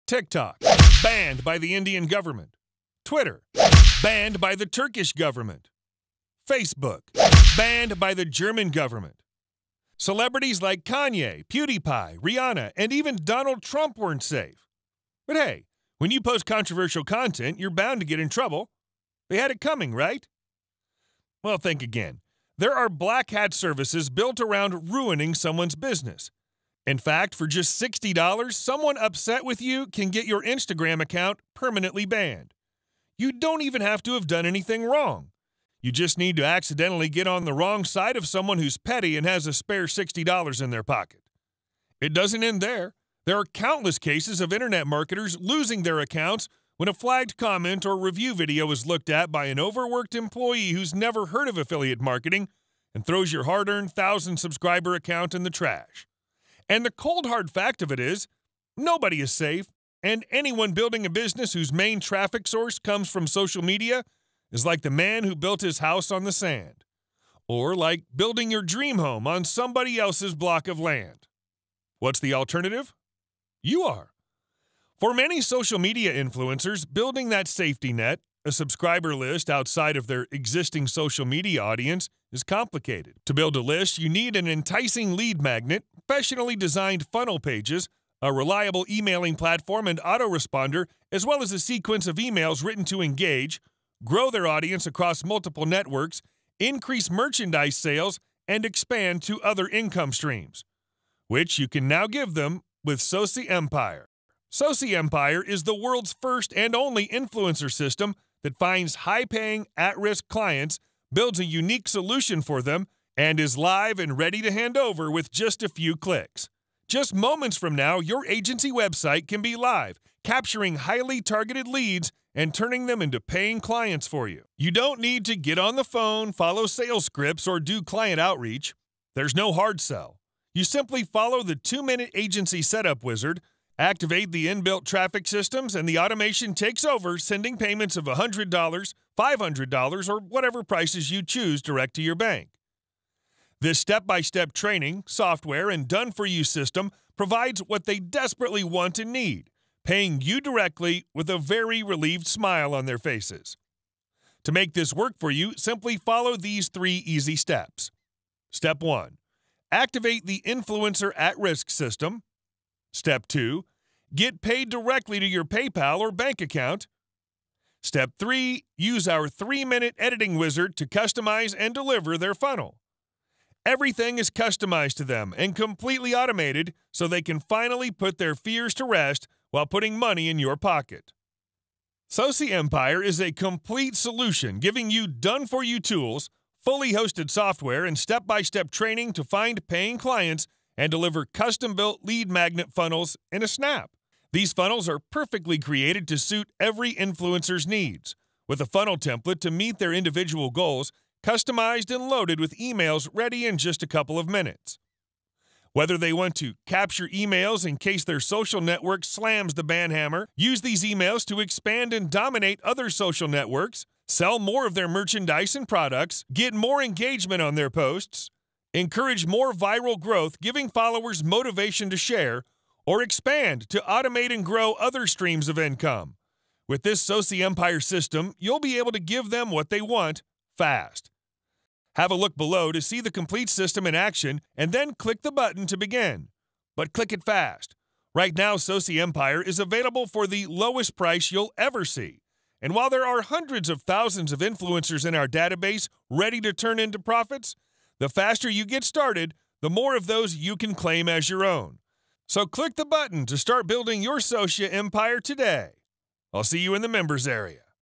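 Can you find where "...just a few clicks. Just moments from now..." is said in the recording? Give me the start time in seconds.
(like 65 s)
115 s.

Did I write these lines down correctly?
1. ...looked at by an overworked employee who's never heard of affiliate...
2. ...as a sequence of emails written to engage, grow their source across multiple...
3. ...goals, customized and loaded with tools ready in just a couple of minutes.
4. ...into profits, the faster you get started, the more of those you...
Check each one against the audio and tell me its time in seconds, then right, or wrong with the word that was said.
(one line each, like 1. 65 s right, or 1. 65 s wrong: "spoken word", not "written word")
1. 48 s right
2. 91 s wrong: "audience", not "source"
3. 200 s wrong: "emails", not "tools"
4. 246 s right.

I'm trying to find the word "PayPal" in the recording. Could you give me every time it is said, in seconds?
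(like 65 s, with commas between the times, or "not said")
165 s.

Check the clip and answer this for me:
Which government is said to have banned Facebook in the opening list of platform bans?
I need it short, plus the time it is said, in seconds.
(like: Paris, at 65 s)
German, at 8 s.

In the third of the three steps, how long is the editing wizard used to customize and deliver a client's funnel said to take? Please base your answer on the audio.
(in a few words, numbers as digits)
3 minutes.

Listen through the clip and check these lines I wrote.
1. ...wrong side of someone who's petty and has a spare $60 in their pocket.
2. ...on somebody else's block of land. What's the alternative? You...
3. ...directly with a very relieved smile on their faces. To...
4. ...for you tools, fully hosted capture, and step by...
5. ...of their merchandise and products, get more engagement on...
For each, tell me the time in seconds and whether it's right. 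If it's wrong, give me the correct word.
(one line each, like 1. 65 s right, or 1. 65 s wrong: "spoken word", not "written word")
1. 37 s right
2. 69 s right
3. 150 s right
4. 185 s wrong: "software", not "capture"
5. 214 s right.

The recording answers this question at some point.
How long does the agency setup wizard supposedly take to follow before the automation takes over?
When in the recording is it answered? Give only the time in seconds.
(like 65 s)
131 s.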